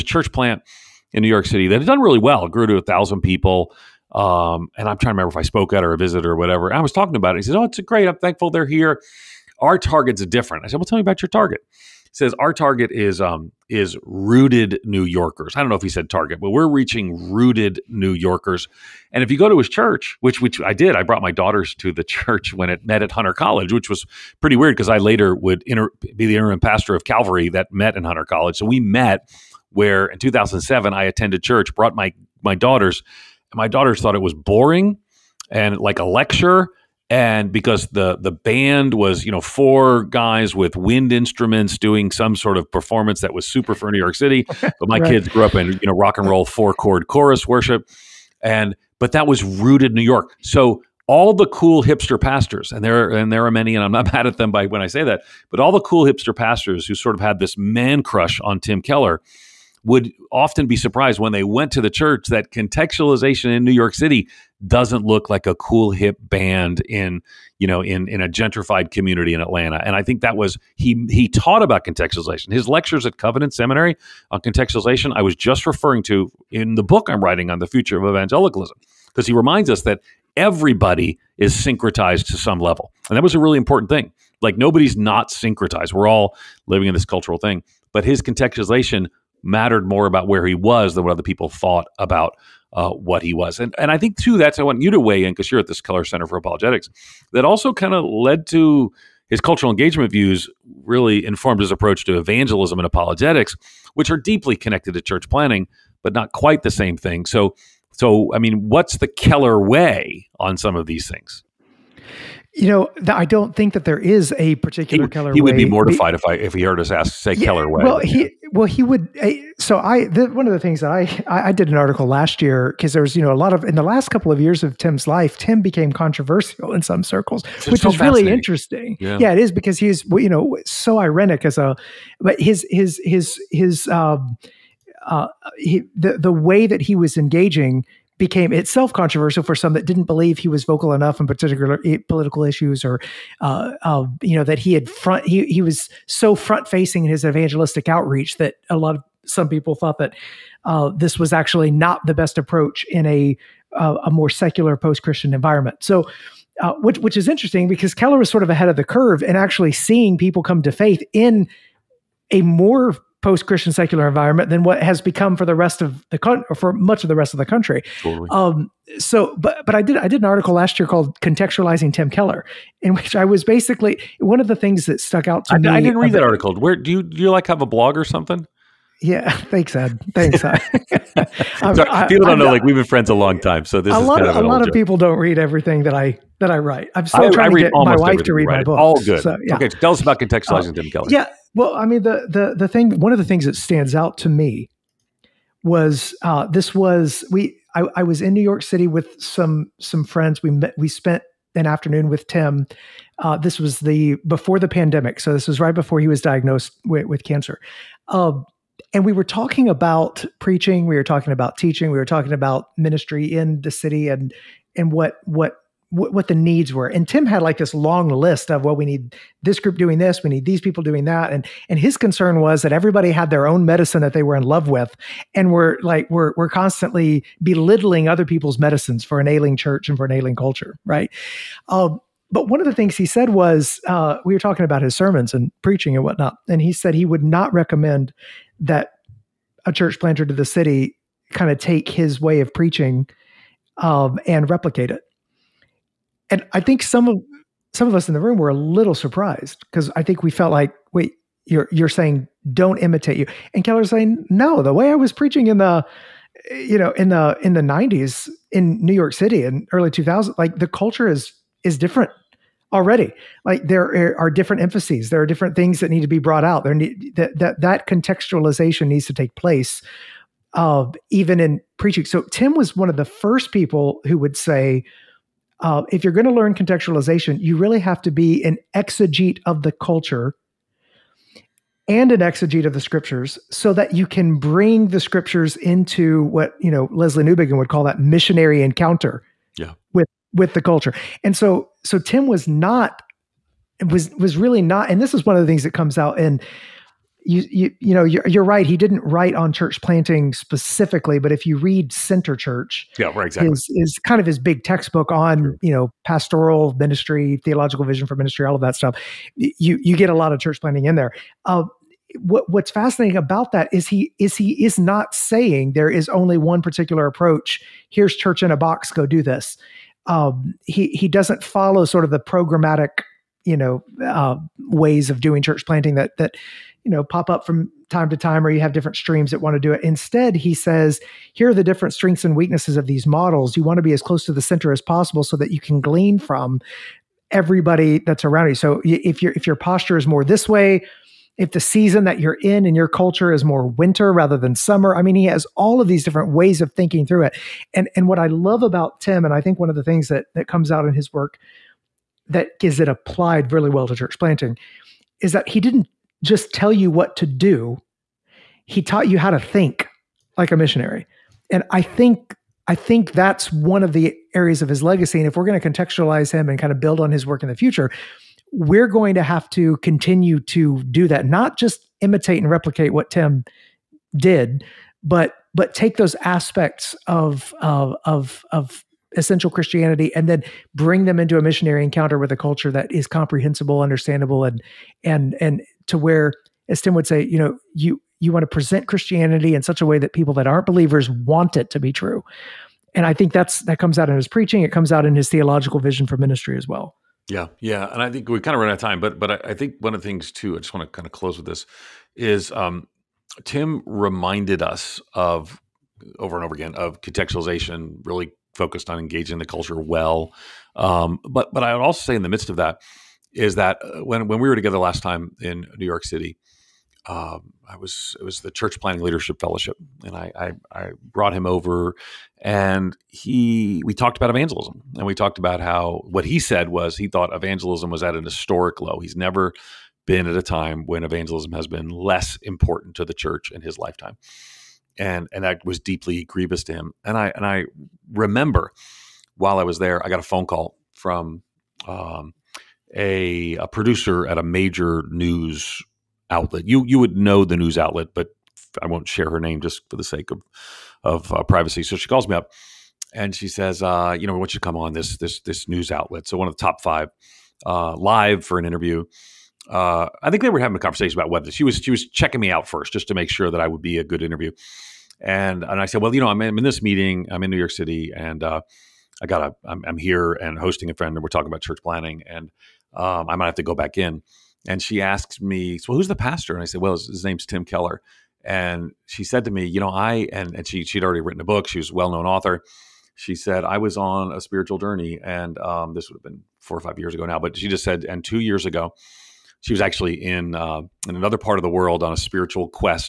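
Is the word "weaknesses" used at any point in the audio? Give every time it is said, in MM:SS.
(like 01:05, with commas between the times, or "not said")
05:32.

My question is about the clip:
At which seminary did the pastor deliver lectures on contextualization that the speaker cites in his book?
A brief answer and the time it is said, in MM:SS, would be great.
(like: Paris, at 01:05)
Covenant Seminary, at 01:13.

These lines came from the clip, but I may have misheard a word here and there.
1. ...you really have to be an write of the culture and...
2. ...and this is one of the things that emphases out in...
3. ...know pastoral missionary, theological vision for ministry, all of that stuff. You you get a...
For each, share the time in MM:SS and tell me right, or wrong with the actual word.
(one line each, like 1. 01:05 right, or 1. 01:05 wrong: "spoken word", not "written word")
1. 04:37 wrong: "exegete", not "write"
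2. 04:54 wrong: "comes", not "emphases"
3. 05:05 wrong: "ministry", not "missionary".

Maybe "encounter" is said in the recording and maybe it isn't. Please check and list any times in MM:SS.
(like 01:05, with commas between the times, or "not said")
04:48, 06:21.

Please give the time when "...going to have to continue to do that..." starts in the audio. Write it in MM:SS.
06:08.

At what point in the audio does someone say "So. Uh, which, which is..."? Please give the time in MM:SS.
02:35.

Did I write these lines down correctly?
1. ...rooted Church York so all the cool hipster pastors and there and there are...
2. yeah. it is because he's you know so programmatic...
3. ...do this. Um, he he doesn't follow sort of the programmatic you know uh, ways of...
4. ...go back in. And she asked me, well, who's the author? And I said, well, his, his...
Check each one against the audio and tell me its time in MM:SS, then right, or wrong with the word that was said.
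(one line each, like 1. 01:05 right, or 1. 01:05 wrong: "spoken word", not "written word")
1. 00:49 wrong: "New", not "Church"
2. 02:09 wrong: "ironic", not "programmatic"
3. 05:19 right
4. 07:53 wrong: "pastor", not "author".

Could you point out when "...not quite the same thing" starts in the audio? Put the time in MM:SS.
01:46.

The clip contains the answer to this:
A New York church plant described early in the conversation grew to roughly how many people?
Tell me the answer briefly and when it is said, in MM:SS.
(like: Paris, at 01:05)
1000, at 00:02.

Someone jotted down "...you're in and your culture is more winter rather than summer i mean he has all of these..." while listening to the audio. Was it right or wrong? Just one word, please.
right.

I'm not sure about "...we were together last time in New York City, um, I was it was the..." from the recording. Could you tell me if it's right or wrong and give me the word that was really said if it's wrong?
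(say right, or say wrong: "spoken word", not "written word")
right.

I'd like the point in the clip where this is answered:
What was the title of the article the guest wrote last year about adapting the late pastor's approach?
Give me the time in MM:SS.
02:51.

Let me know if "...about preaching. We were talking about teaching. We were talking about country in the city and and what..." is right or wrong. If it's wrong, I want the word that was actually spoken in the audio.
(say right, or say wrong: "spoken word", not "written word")
wrong: "ministry", not "country".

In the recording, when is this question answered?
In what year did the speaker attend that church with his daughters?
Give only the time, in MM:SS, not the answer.
00:30.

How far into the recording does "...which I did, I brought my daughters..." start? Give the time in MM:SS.
00:20.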